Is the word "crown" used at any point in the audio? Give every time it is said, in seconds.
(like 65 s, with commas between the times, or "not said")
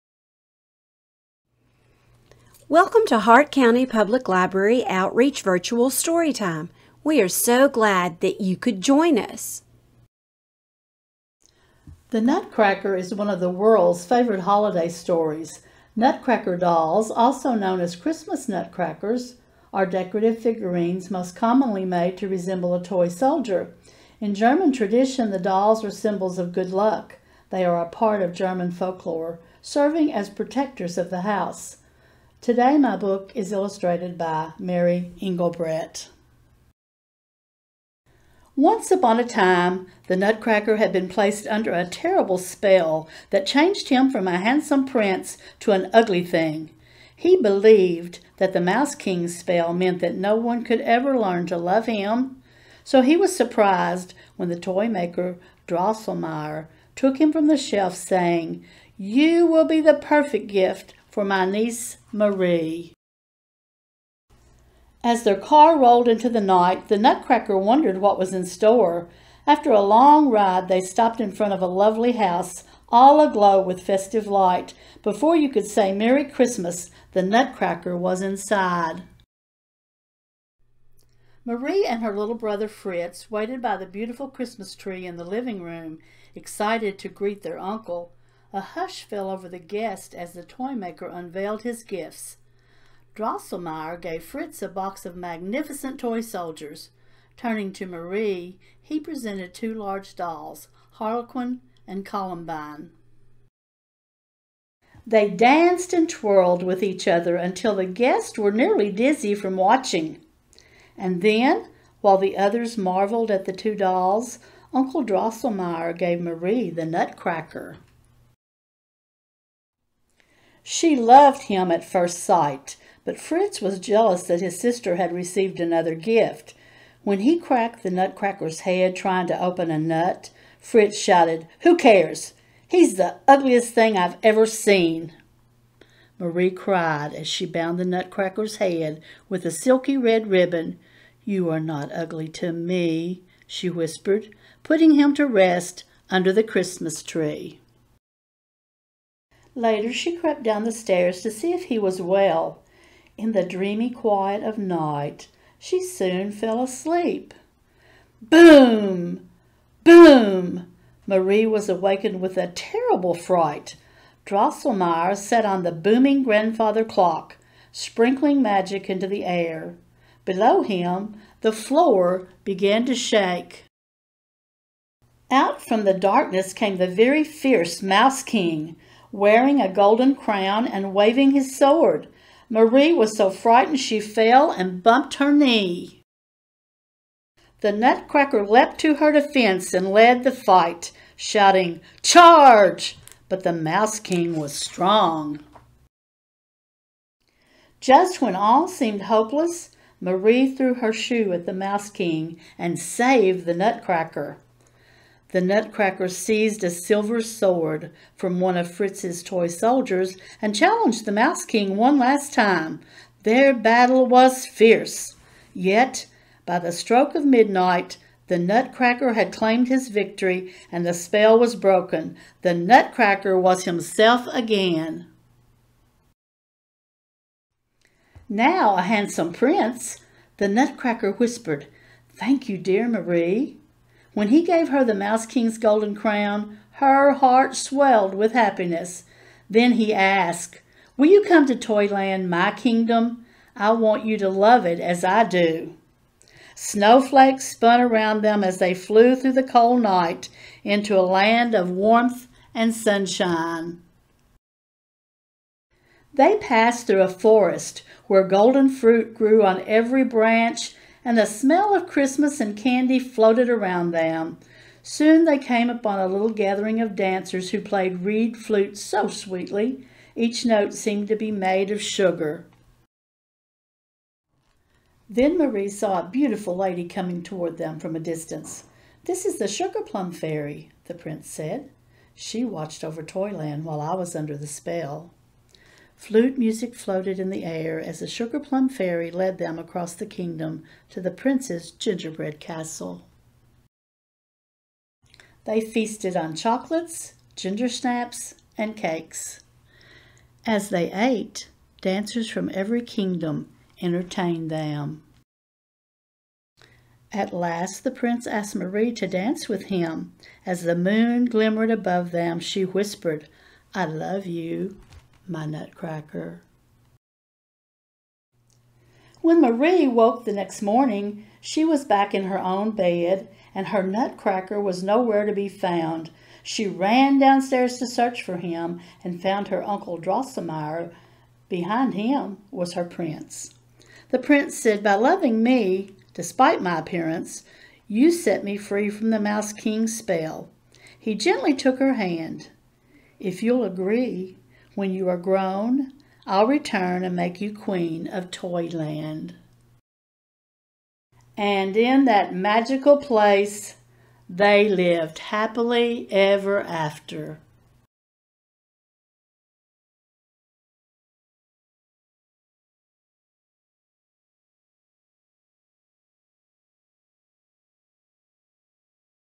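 180 s, 235 s.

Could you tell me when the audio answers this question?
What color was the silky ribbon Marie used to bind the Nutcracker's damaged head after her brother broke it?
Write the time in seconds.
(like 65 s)
139 s.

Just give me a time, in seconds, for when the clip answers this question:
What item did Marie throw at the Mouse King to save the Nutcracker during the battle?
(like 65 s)
200 s.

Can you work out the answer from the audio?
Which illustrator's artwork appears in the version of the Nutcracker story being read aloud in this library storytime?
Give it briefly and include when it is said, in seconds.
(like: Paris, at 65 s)
Mary Engelbreit, at 34 s.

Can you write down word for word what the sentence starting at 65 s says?
As their car rolled into the night, the Nutcracker wondered what was in store.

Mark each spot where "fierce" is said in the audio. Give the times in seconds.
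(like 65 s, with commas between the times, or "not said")
177 s, 214 s.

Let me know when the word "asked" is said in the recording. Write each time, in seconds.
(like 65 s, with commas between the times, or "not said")
239 s, 308 s.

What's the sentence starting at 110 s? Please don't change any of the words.
And then, while the others marveled at the two dolls, Uncle Drosselmeyer gave Marie the nutcracker.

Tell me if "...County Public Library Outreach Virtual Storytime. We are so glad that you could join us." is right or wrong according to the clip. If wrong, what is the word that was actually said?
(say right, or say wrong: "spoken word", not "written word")
right.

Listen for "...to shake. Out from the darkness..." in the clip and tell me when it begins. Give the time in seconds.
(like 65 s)
172 s.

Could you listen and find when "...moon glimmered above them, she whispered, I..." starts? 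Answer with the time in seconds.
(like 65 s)
310 s.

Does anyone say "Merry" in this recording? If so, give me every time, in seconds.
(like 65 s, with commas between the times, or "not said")
75 s.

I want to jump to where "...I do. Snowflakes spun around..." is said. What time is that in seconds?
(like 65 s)
245 s.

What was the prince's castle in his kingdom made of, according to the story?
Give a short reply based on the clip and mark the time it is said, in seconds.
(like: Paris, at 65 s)
Gingerbread, at 291 s.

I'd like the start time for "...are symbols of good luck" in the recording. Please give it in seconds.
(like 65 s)
25 s.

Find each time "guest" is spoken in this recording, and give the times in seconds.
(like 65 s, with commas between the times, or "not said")
89 s, 107 s.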